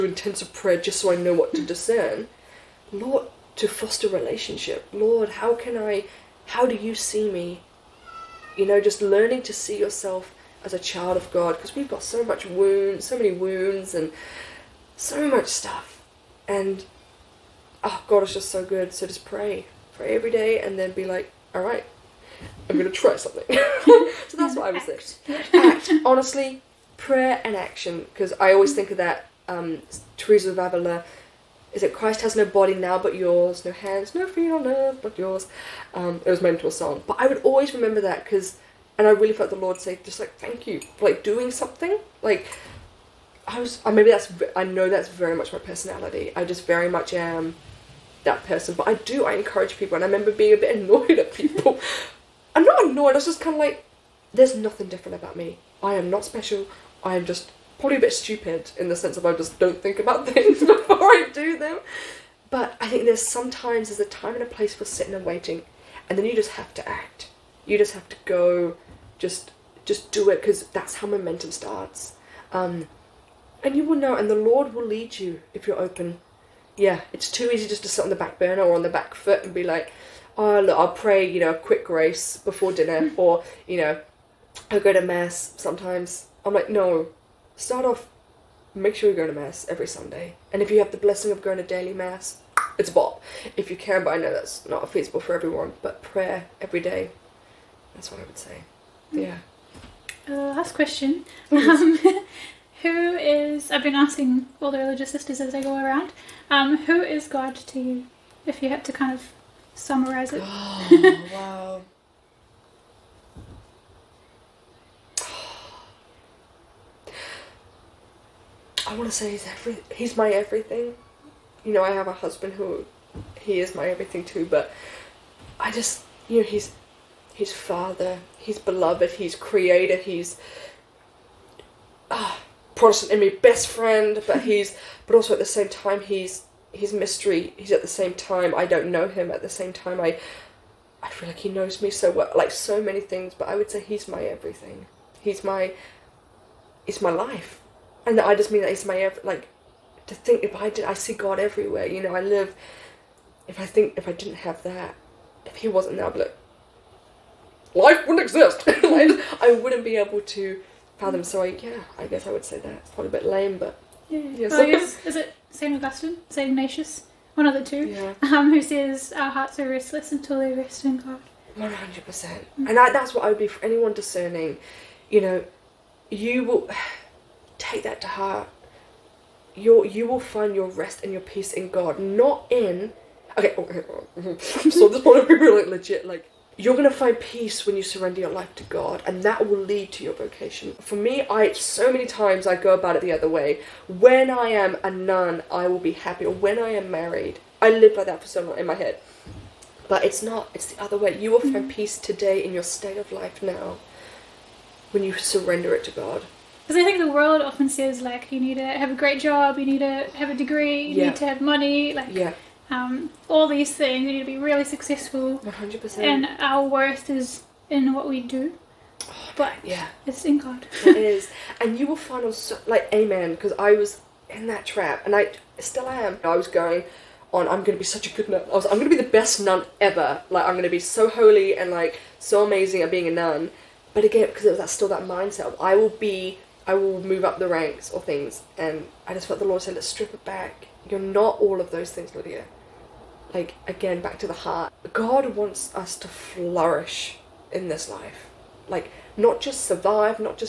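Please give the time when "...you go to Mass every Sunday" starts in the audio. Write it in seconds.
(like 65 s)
89 s.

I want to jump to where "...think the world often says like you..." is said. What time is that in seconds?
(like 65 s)
206 s.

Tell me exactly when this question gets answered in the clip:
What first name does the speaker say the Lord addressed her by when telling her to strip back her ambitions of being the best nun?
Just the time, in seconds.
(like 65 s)
242 s.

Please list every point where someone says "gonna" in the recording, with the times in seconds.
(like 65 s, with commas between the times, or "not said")
22 s, 186 s.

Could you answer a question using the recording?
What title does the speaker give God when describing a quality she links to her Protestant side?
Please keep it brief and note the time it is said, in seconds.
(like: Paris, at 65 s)
best friend, at 133 s.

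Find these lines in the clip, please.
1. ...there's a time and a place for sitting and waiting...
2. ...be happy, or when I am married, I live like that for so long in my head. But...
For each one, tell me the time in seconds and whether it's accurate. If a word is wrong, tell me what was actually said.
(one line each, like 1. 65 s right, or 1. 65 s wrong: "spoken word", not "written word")
1. 63 s right
2. 195 s right.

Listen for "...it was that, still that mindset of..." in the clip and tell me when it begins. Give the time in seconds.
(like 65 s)
234 s.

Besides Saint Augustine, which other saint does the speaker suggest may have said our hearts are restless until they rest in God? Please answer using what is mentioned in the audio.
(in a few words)
Saint Ignatius.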